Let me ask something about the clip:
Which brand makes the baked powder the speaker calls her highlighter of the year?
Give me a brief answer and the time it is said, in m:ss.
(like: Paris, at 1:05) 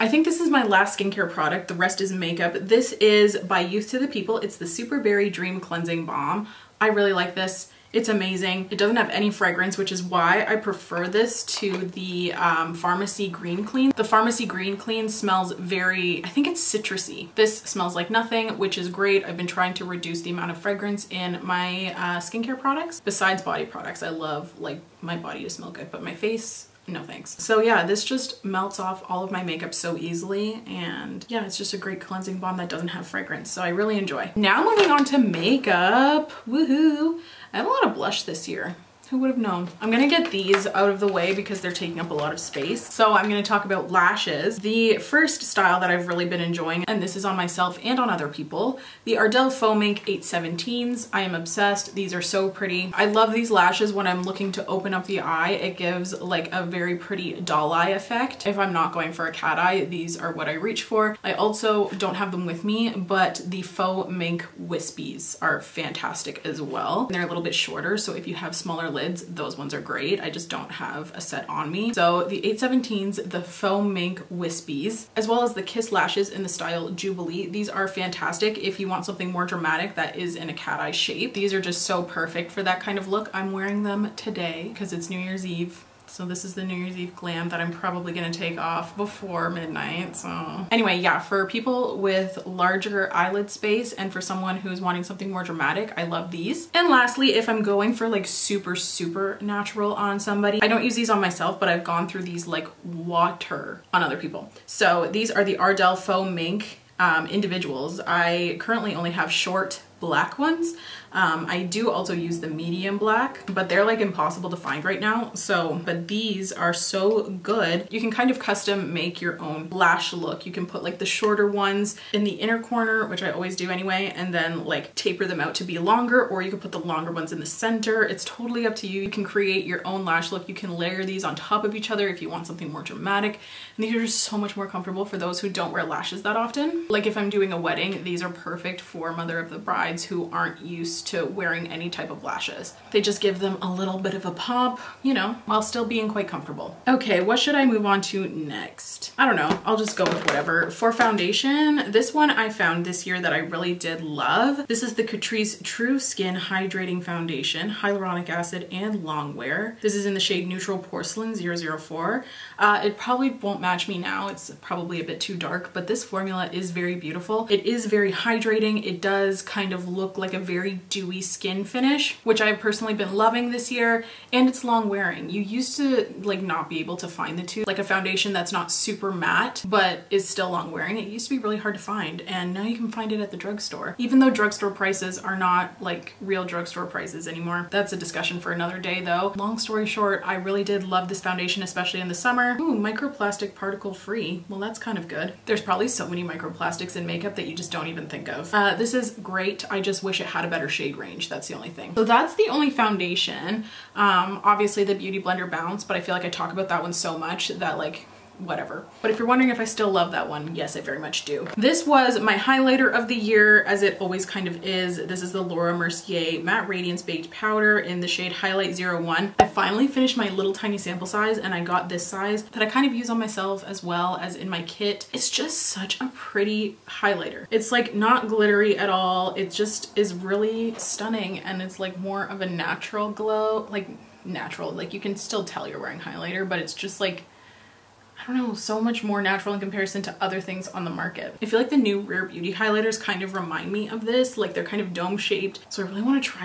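Laura Mercier, at 3:35.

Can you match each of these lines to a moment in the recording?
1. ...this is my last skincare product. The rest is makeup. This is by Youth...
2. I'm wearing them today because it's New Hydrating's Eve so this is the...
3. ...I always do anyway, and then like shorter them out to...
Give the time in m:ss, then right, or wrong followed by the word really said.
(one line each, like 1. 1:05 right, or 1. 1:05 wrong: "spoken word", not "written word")
1. 0:00 right
2. 1:23 wrong: "Year", not "Hydrating"
3. 2:03 wrong: "taper", not "shorter".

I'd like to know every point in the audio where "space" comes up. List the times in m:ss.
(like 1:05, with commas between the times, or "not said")
0:42, 1:33.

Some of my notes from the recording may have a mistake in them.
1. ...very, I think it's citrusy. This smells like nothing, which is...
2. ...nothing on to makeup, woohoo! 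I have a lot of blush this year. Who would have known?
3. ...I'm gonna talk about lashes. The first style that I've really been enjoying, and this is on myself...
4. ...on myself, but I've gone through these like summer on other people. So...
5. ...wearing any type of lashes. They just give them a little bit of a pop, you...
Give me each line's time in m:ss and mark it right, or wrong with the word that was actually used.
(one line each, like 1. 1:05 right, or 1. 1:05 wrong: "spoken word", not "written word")
1. 0:15 right
2. 0:34 wrong: "moving", not "nothing"
3. 0:43 right
4. 1:41 wrong: "water", not "summer"
5. 2:21 right.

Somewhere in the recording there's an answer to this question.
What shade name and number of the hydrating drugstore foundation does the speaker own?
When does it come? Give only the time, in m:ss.
2:40.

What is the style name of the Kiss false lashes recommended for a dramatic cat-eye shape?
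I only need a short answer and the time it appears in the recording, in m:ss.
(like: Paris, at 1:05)
Jubilee, at 1:16.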